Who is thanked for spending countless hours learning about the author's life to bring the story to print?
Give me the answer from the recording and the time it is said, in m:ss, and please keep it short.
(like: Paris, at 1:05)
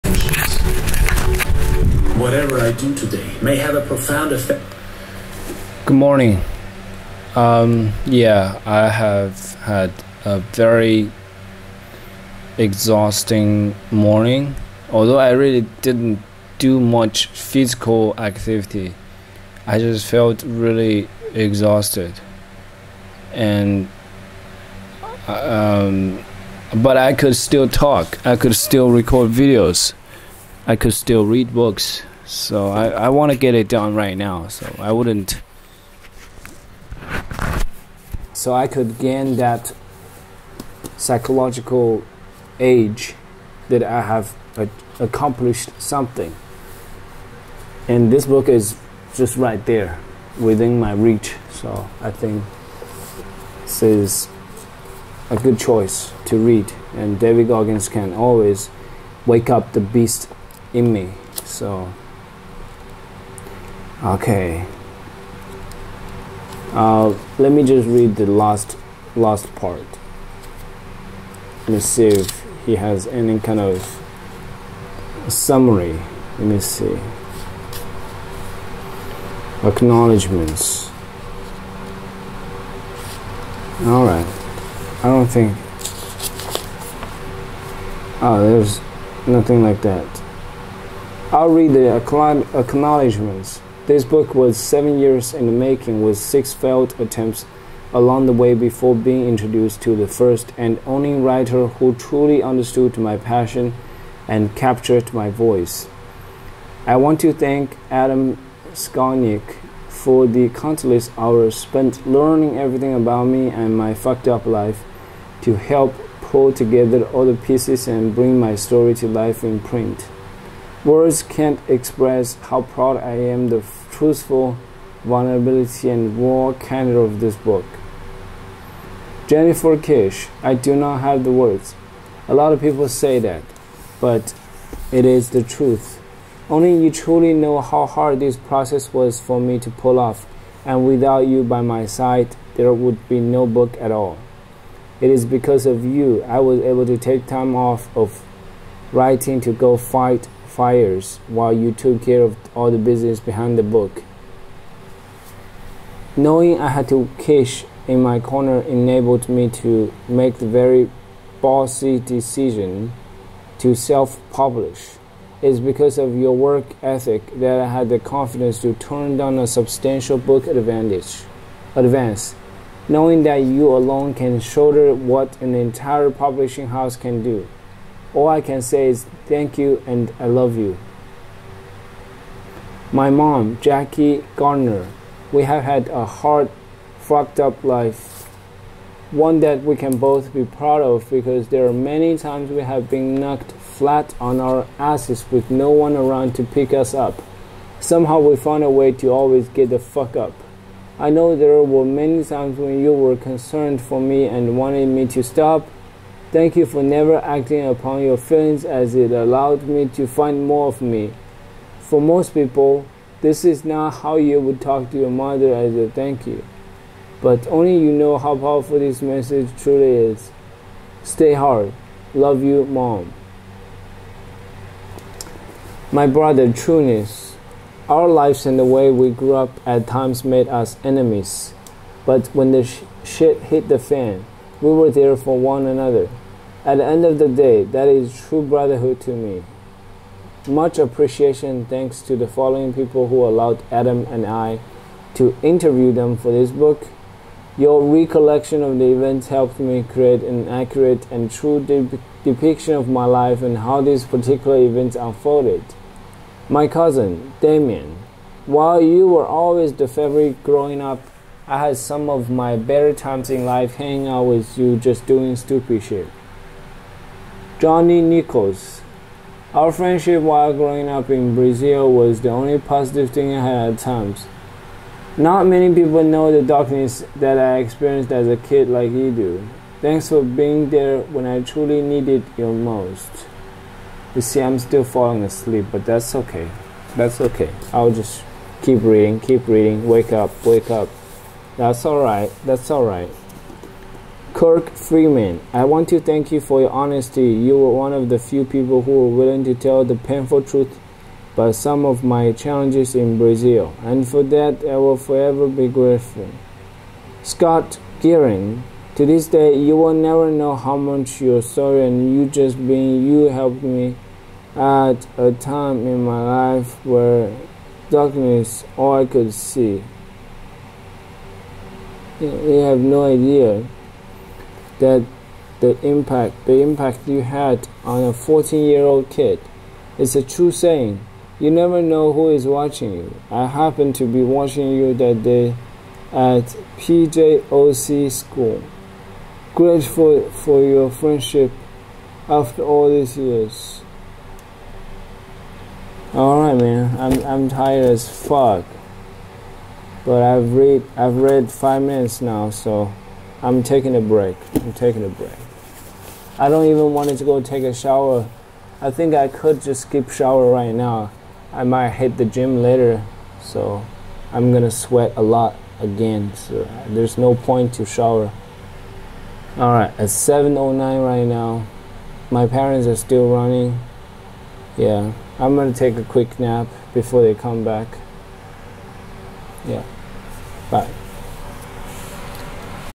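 Adam Skolnick, at 1:47.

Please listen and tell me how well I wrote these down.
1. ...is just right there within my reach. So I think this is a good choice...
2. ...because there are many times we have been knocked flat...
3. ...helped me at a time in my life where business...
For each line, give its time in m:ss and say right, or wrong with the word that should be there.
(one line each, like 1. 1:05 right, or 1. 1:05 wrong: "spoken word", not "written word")
1. 0:48 right
2. 3:11 right
3. 5:13 wrong: "darkness", not "business".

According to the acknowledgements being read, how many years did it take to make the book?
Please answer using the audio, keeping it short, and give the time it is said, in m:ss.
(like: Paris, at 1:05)
7, at 1:34.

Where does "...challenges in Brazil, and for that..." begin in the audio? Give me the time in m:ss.
5:02.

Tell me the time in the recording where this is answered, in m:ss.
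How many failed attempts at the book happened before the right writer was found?
1:36.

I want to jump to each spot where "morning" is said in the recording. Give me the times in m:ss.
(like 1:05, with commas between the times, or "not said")
0:05, 0:13.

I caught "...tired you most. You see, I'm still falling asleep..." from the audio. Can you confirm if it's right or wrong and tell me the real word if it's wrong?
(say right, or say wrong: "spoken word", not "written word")
wrong: "needed", not "tired".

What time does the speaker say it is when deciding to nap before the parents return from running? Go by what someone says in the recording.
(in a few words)
7:09.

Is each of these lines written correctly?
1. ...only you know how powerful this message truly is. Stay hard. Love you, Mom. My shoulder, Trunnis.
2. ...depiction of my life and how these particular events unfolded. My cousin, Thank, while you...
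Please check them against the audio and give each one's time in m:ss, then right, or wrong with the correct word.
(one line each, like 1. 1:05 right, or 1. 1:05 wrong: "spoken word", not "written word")
1. 3:37 wrong: "brother", not "shoulder"
2. 4:12 wrong: "Damien", not "Thank".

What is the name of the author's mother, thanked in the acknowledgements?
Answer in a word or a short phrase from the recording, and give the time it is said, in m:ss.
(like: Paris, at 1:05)
Jackie Gardner, at 3:03.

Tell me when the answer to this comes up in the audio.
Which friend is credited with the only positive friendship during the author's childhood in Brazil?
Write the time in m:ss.
4:27.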